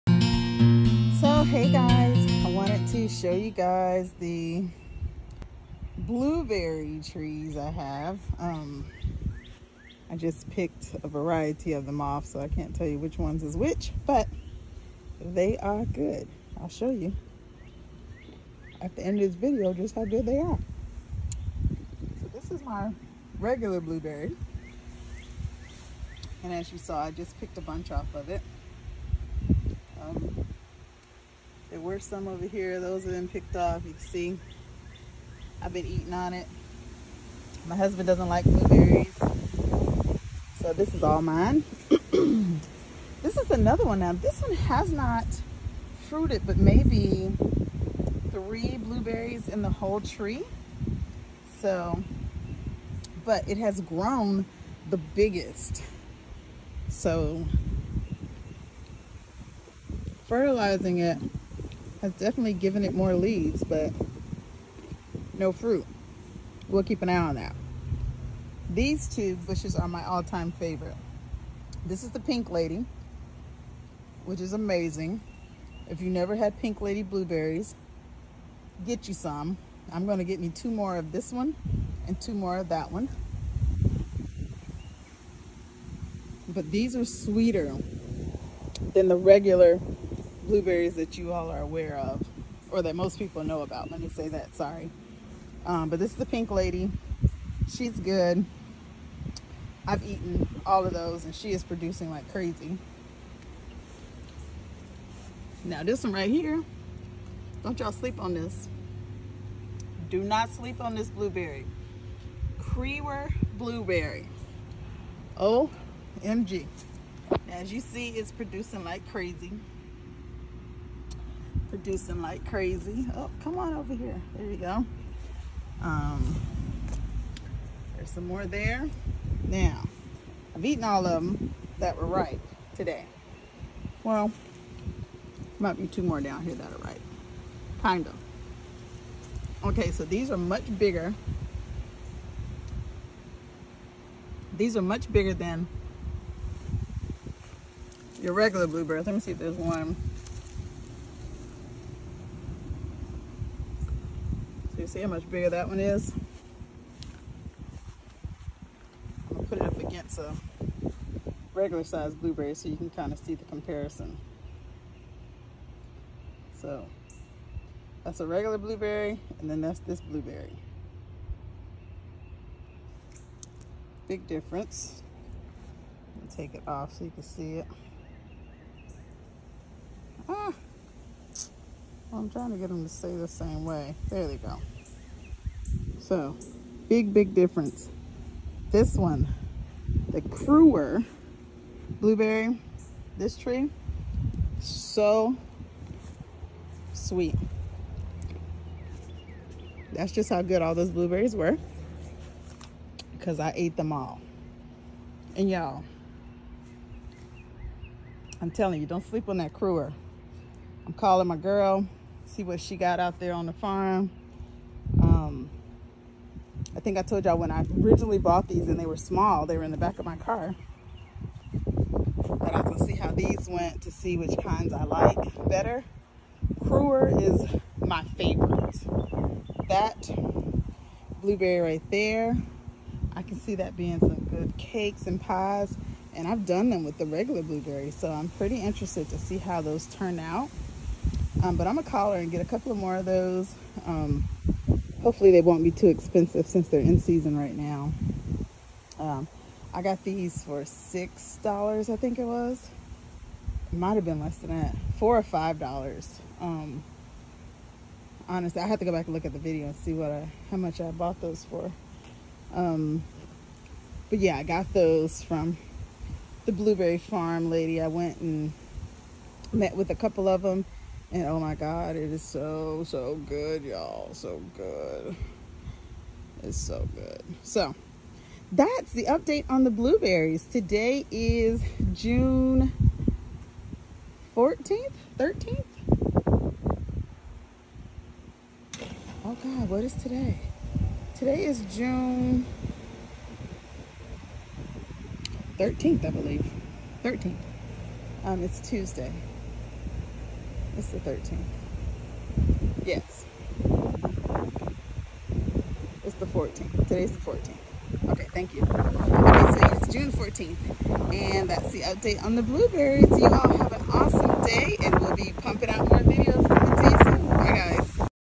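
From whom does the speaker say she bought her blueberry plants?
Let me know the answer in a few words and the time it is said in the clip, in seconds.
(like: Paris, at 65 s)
the Blueberry Farm lady, at 266 s.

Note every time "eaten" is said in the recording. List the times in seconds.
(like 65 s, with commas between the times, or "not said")
100 s, 130 s.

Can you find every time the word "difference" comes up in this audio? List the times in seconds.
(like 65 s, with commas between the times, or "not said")
174 s, 187 s.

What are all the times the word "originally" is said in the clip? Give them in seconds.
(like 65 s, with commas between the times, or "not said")
217 s.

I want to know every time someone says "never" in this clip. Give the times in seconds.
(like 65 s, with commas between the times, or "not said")
76 s.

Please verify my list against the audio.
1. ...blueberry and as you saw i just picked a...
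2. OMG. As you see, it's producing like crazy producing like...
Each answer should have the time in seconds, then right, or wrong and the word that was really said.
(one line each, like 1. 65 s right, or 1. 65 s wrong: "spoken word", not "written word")
1. 23 s right
2. 115 s right.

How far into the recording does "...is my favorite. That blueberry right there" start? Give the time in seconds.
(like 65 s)
227 s.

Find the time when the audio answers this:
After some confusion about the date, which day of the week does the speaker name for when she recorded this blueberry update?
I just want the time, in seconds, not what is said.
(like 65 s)
298 s.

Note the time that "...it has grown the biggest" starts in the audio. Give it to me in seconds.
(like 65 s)
53 s.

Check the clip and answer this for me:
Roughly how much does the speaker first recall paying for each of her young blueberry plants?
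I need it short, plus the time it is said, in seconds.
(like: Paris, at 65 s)
$6, at 250 s.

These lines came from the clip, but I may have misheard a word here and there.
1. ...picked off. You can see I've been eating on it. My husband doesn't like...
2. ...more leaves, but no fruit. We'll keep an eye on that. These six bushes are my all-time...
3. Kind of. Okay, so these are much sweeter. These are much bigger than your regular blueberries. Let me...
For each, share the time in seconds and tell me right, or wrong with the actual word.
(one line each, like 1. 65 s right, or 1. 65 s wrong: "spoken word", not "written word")
1. 33 s right
2. 62 s wrong: "two", not "six"
3. 137 s wrong: "bigger", not "sweeter".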